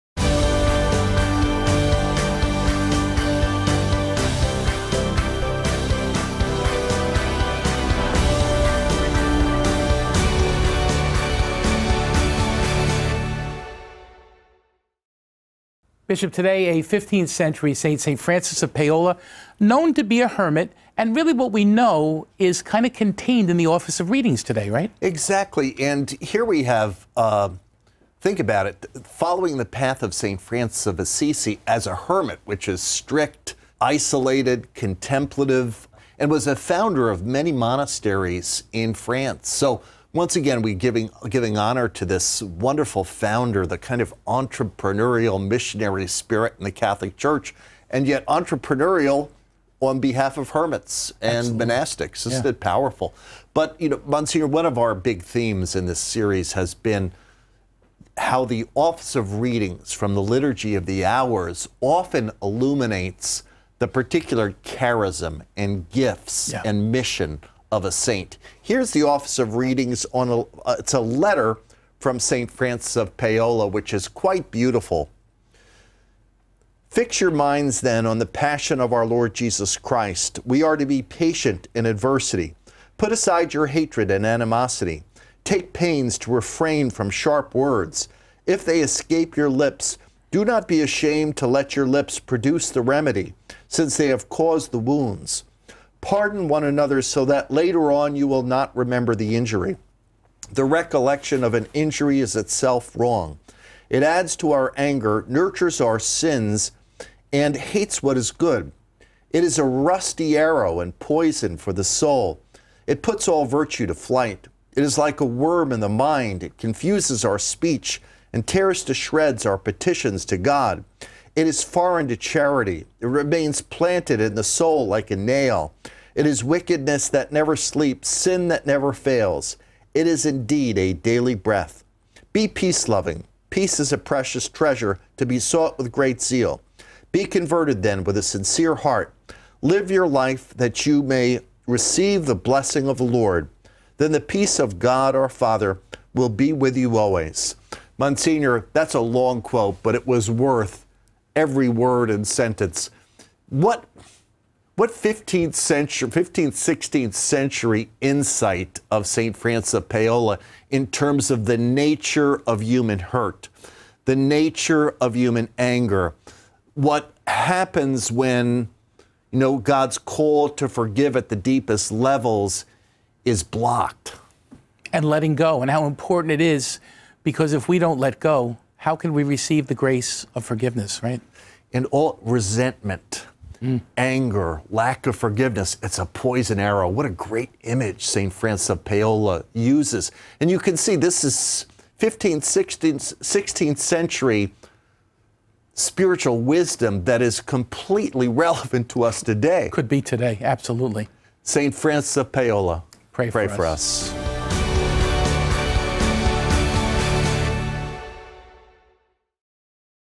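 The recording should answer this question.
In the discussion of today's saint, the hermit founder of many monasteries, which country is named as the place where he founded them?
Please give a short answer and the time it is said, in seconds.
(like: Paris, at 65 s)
France, at 38 s.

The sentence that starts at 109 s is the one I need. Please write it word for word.
It is a rusty arrow and poison for the soul.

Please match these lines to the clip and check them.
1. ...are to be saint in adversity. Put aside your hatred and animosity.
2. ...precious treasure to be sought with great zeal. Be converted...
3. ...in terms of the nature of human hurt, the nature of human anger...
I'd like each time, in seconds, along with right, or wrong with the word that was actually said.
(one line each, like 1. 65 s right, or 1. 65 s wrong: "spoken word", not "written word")
1. 80 s wrong: "patient", not "saint"
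2. 133 s right
3. 160 s right.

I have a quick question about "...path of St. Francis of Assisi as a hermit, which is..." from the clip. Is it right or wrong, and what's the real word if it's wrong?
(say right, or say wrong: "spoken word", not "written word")
right.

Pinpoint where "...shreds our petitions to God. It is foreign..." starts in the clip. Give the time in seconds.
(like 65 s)
118 s.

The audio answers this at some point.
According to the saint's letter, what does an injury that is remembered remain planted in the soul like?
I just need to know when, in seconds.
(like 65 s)
125 s.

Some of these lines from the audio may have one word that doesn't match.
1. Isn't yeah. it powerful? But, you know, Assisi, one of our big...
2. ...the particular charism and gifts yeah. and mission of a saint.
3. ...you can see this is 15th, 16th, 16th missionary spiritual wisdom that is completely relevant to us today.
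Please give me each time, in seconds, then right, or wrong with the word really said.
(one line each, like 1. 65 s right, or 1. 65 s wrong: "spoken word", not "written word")
1. 52 s wrong: "Monsignor", not "Assisi"
2. 63 s right
3. 190 s wrong: "century", not "missionary".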